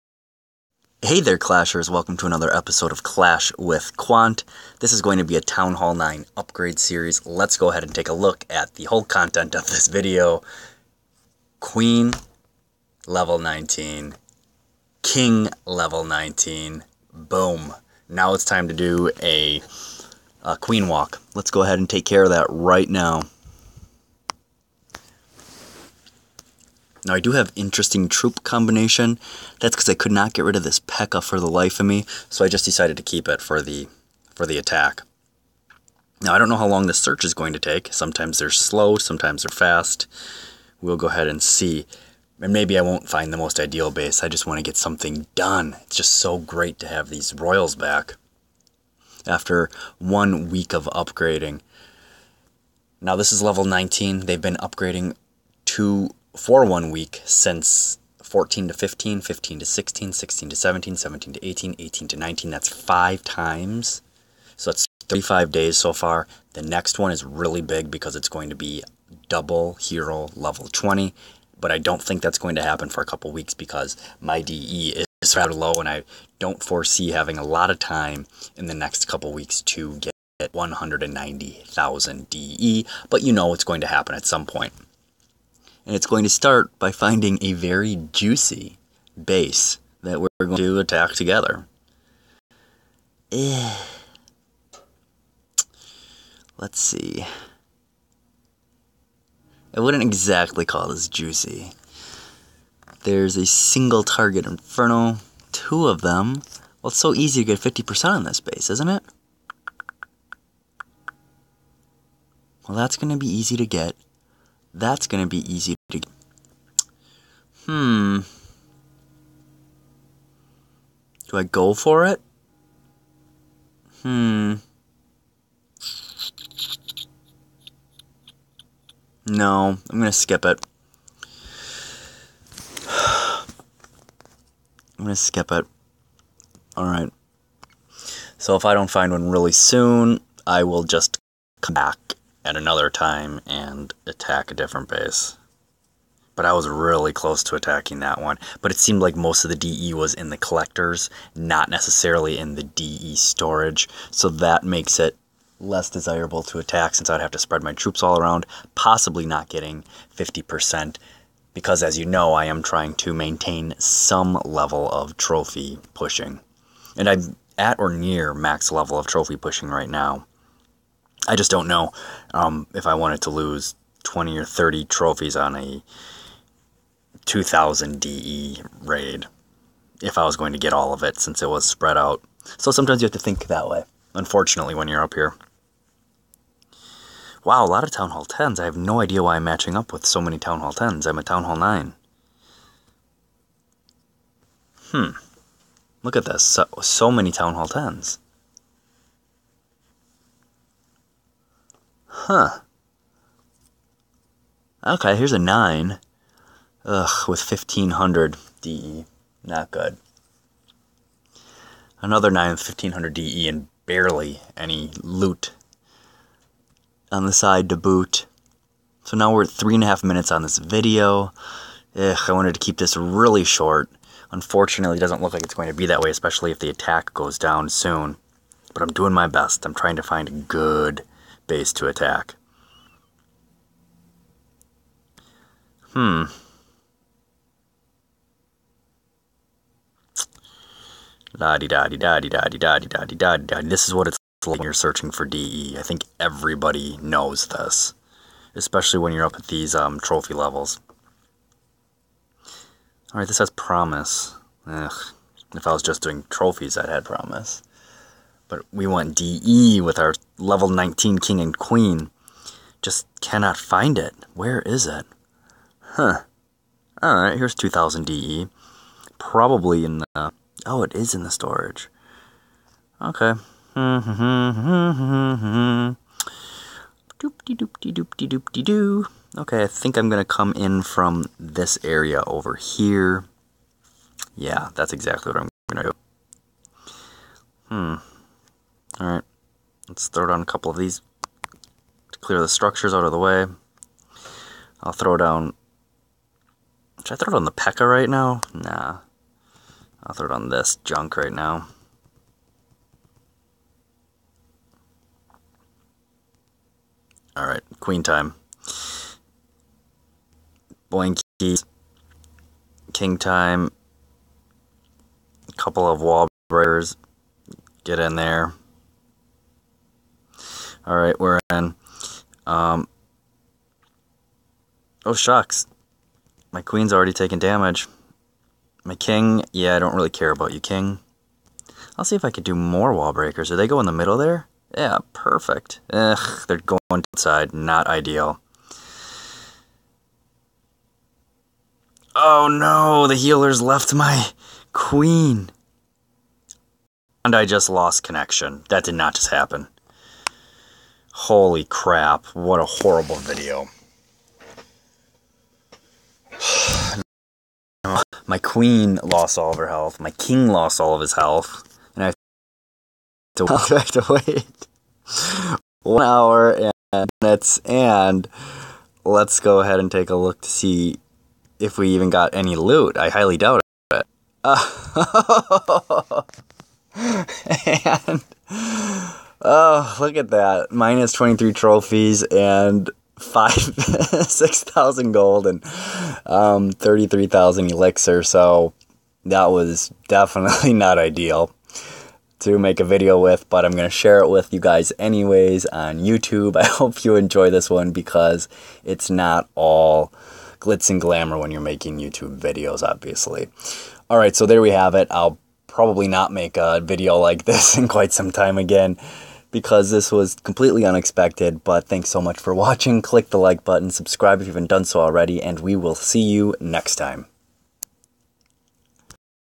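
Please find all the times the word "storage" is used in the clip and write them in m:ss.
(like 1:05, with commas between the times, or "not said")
2:33, 4:31.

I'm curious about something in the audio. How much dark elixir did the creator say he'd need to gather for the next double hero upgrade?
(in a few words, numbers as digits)
190,000.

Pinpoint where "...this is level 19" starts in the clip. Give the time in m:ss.
0:53.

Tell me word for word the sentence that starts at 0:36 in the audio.
Now I don't know how long the search is going to take.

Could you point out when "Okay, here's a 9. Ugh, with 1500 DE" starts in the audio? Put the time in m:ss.
3:24.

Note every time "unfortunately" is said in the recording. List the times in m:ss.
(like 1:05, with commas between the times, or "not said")
3:04, 3:44.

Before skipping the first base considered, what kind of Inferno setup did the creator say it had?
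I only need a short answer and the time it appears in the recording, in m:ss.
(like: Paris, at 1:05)
Single target, at 1:43.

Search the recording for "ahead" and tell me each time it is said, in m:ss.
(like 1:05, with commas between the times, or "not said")
0:07, 0:21, 0:41, 6:09.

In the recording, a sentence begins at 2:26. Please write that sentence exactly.
But I was really close to attacking that one.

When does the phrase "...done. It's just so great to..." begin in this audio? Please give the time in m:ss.
0:45.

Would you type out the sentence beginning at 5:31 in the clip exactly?
I'll see if I could do more wall breakers.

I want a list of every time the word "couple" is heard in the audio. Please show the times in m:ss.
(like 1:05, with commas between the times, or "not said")
1:13, 1:19, 4:50, 5:15.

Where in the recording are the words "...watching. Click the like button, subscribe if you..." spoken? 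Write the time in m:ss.
6:52.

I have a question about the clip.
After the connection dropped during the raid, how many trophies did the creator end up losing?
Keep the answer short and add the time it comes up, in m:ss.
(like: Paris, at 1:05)
23, at 6:21.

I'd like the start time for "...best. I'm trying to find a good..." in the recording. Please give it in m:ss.
3:49.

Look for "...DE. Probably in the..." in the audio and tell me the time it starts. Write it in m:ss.
4:28.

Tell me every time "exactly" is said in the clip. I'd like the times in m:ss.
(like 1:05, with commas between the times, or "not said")
1:40, 4:44.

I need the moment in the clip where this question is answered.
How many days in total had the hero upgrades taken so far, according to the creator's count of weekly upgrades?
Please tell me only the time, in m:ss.
1:05.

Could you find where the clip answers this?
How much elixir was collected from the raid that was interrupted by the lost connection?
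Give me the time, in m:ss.
6:26.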